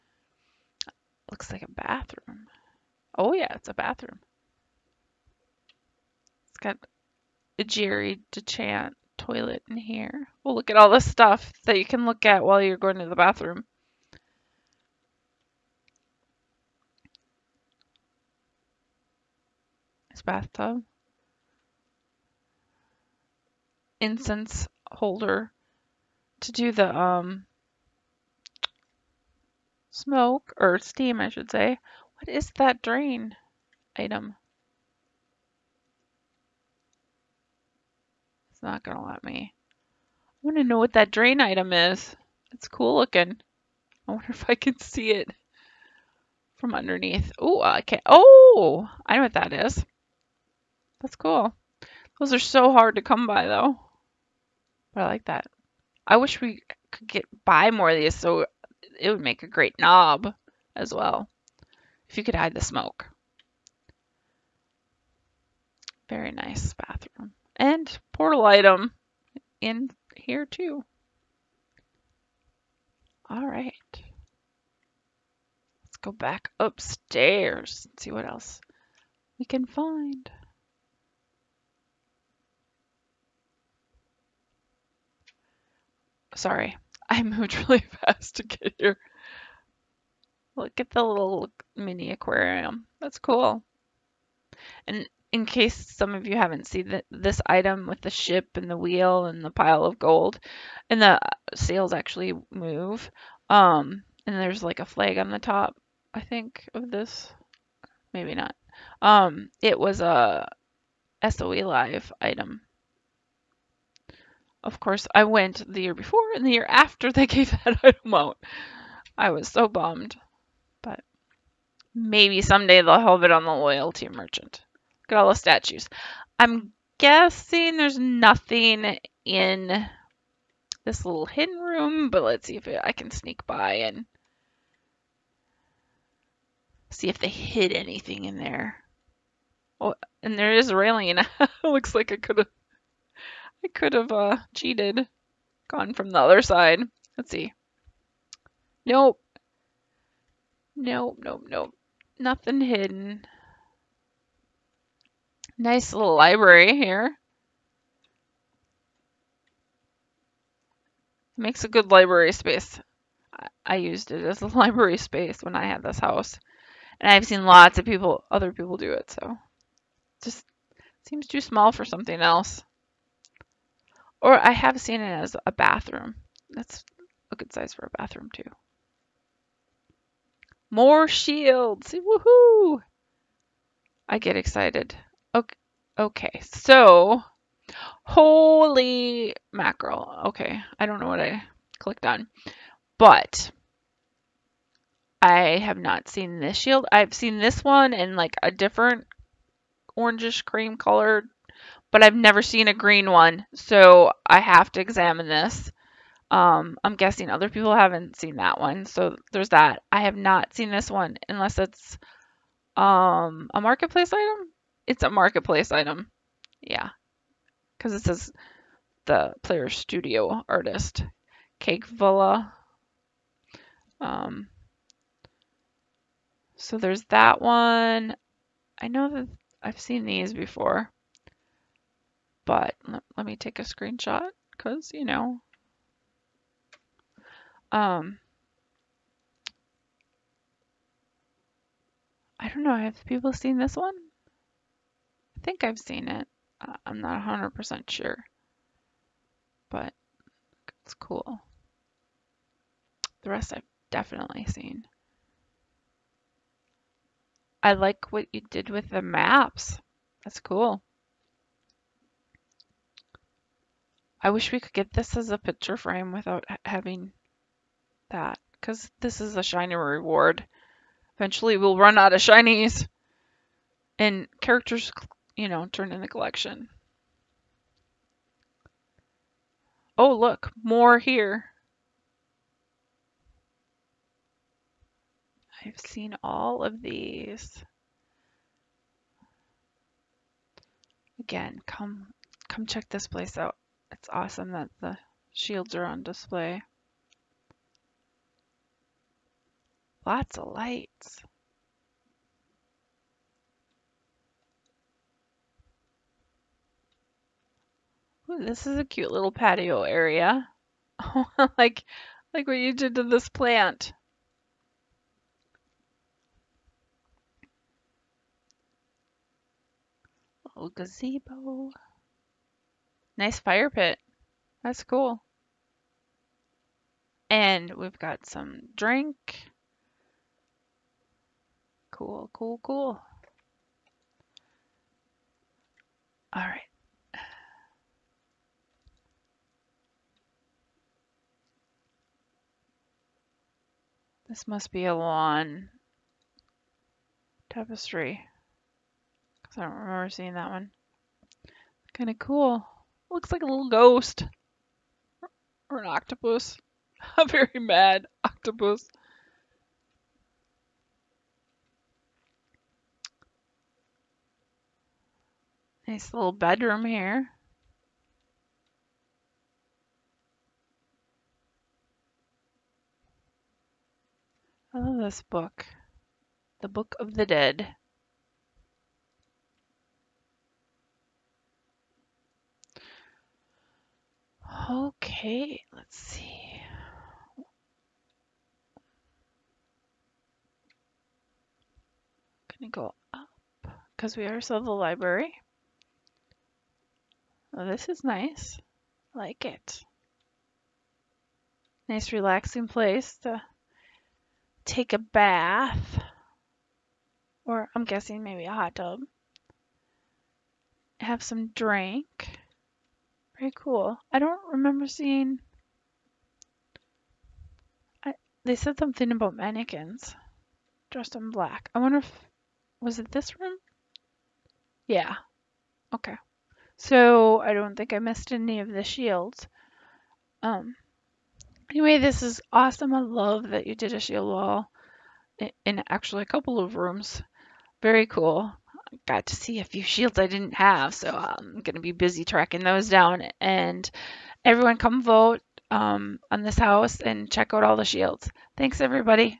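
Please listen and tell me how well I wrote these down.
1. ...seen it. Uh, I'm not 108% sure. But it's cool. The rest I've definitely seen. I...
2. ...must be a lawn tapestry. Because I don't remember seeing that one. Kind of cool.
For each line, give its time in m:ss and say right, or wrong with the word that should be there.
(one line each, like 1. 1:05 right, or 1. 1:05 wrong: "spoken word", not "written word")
1. 4:05 wrong: "100", not "108"
2. 5:44 right.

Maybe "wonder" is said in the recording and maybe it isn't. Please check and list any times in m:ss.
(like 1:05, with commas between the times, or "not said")
0:44, 7:01.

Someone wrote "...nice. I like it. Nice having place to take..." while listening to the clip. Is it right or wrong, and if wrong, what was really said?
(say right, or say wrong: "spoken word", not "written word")
wrong: "relaxing", not "having".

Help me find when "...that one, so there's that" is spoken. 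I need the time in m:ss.
3:28.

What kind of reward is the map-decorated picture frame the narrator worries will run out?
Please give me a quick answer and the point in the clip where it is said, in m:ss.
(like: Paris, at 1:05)
shiny reward, at 4:29.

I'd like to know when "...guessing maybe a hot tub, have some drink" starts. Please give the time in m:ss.
6:47.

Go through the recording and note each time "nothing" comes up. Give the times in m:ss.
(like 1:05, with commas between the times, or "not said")
2:07, 2:32.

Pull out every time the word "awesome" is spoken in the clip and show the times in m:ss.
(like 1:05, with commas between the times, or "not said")
4:54, 7:12.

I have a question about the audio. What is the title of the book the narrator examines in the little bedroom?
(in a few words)
The Book of the Dead.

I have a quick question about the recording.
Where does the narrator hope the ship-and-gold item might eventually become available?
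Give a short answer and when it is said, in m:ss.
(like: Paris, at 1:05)
loyalty merchant, at 2:03.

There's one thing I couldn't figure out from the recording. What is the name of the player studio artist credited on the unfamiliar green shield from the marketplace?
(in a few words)
Cake Villa.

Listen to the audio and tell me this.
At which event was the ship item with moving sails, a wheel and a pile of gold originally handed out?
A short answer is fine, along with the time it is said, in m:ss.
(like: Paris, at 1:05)
SOE Live, at 1:51.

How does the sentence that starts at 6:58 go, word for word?
I, they said something about mannequins dressed in black.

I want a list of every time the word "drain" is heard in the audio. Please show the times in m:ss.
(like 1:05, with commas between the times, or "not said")
0:32, 0:41.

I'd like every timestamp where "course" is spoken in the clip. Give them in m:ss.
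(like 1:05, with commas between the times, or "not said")
1:54.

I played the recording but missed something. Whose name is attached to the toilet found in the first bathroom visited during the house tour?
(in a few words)
Jerry DeChant.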